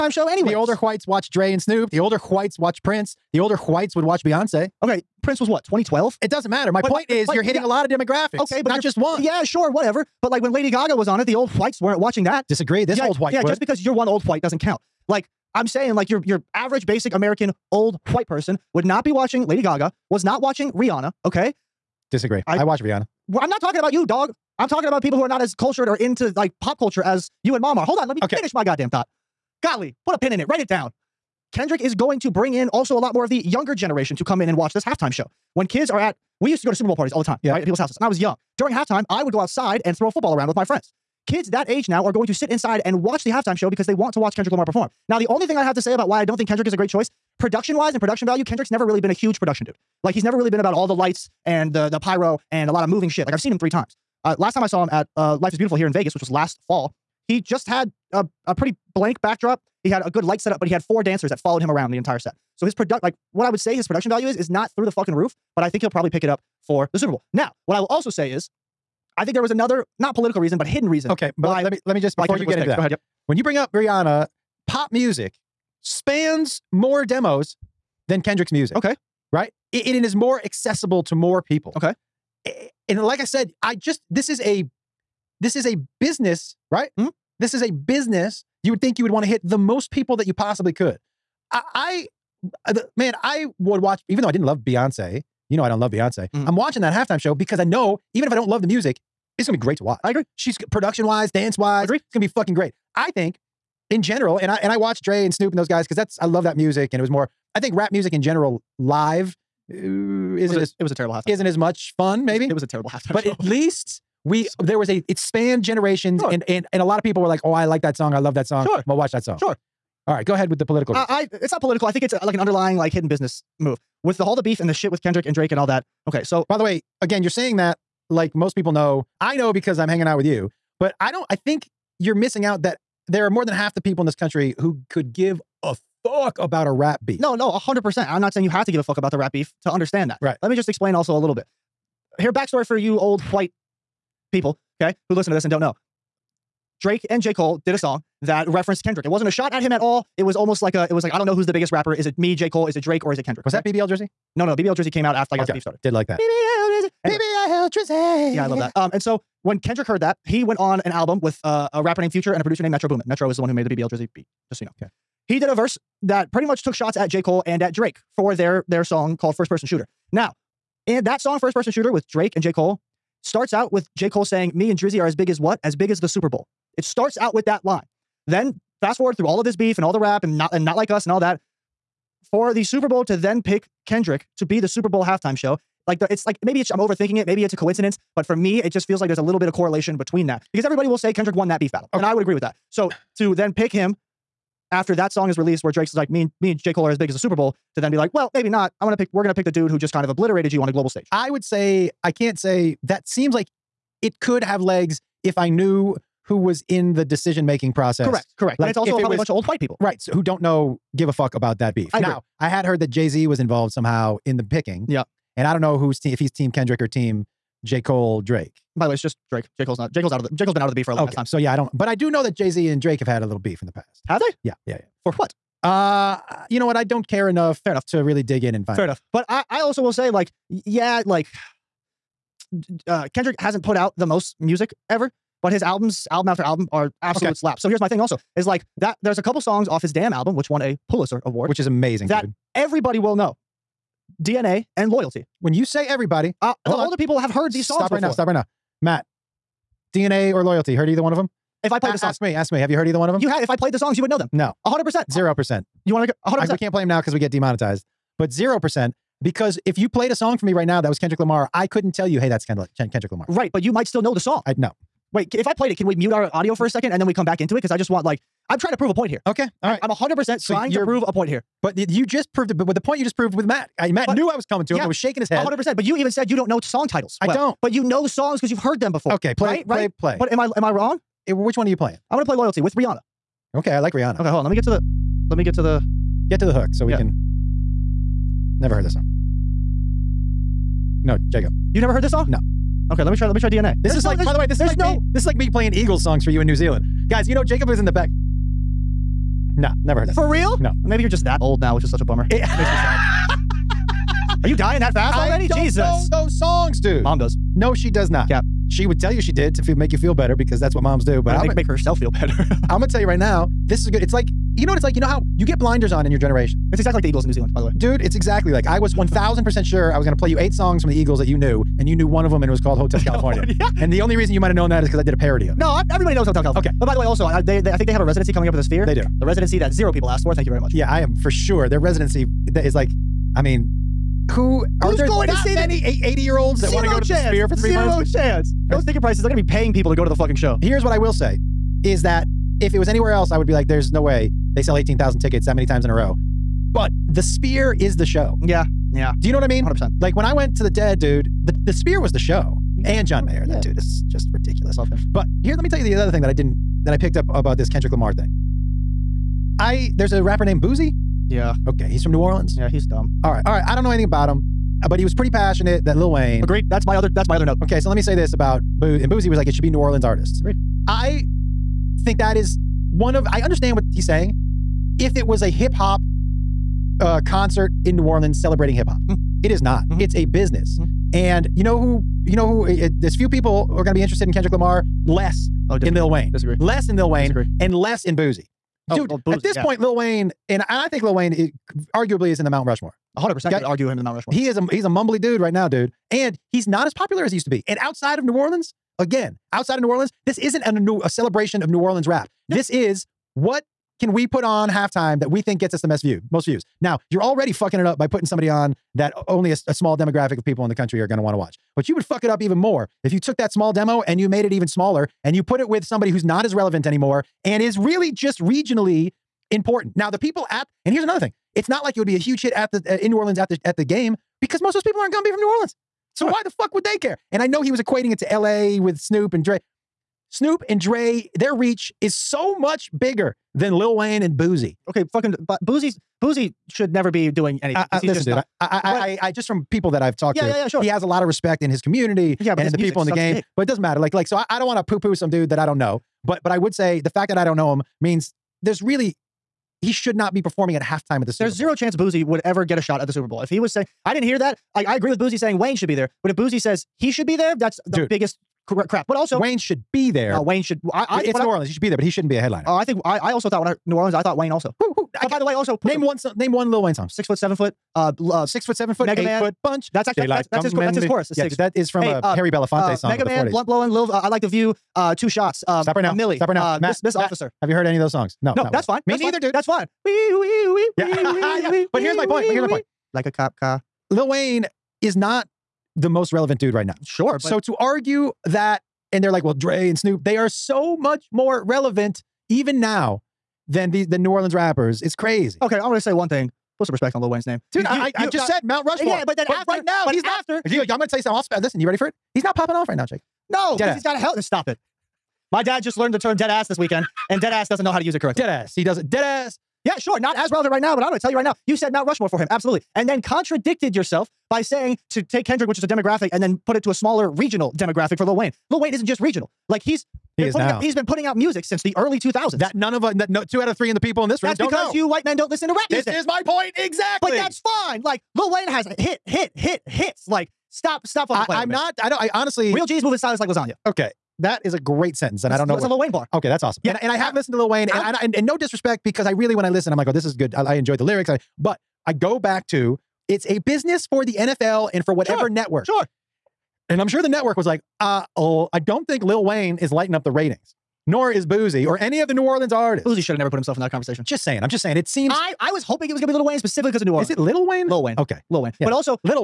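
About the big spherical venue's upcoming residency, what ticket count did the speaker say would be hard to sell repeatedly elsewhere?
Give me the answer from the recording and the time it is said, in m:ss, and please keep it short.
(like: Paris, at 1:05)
18,000, at 5:44.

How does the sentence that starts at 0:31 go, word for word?
Kendrick is going to bring in also a lot more of the younger generation to come in and watch this halftime show.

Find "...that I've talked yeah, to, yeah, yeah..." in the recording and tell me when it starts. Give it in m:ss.
7:19.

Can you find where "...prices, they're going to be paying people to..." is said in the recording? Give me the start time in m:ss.
5:39.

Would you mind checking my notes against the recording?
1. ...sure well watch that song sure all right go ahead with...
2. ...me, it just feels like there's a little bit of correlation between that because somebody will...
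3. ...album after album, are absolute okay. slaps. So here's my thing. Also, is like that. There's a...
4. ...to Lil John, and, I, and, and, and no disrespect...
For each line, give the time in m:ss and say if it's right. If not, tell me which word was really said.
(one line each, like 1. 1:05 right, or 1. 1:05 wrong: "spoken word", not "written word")
1. 1:58 right
2. 3:08 wrong: "everybody", not "somebody"
3. 3:56 right
4. 8:57 wrong: "Wayne", not "John".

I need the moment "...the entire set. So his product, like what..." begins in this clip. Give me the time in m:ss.
1:01.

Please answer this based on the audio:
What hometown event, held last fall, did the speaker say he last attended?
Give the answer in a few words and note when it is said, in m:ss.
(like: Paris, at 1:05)
Life is Beautiful, at 0:55.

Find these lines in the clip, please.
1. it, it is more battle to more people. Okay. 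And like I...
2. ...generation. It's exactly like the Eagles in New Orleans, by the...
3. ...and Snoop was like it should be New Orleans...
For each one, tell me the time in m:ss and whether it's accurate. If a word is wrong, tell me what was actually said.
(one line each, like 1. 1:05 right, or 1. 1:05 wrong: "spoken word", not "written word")
1. 1:19 wrong: "accessible", not "battle"
2. 5:16 wrong: "Zealand", not "Orleans"
3. 6:09 wrong: "Boosie", not "Snoop".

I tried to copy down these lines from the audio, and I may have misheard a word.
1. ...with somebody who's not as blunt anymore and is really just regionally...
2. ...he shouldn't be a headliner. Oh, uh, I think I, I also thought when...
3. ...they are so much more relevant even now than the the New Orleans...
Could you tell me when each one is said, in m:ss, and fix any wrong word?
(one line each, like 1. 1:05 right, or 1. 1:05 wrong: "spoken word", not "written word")
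1. 6:55 wrong: "relevant", not "blunt"
2. 7:42 right
3. 8:10 right.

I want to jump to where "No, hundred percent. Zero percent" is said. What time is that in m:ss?
4:14.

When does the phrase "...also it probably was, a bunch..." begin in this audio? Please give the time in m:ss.
3:28.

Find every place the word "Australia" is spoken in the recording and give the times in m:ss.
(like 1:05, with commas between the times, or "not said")
not said.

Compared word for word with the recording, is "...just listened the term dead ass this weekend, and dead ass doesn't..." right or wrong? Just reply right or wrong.
wrong.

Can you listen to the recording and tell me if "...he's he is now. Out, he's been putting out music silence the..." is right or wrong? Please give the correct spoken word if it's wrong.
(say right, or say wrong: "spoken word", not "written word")
wrong: "since", not "silence".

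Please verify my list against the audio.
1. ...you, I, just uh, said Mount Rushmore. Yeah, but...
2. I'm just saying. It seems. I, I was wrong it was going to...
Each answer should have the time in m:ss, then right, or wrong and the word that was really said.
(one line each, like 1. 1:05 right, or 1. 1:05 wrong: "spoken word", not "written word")
1. 8:18 right
2. 9:14 wrong: "hoping", not "wrong".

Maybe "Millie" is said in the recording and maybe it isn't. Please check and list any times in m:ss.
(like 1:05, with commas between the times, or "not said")
7:56.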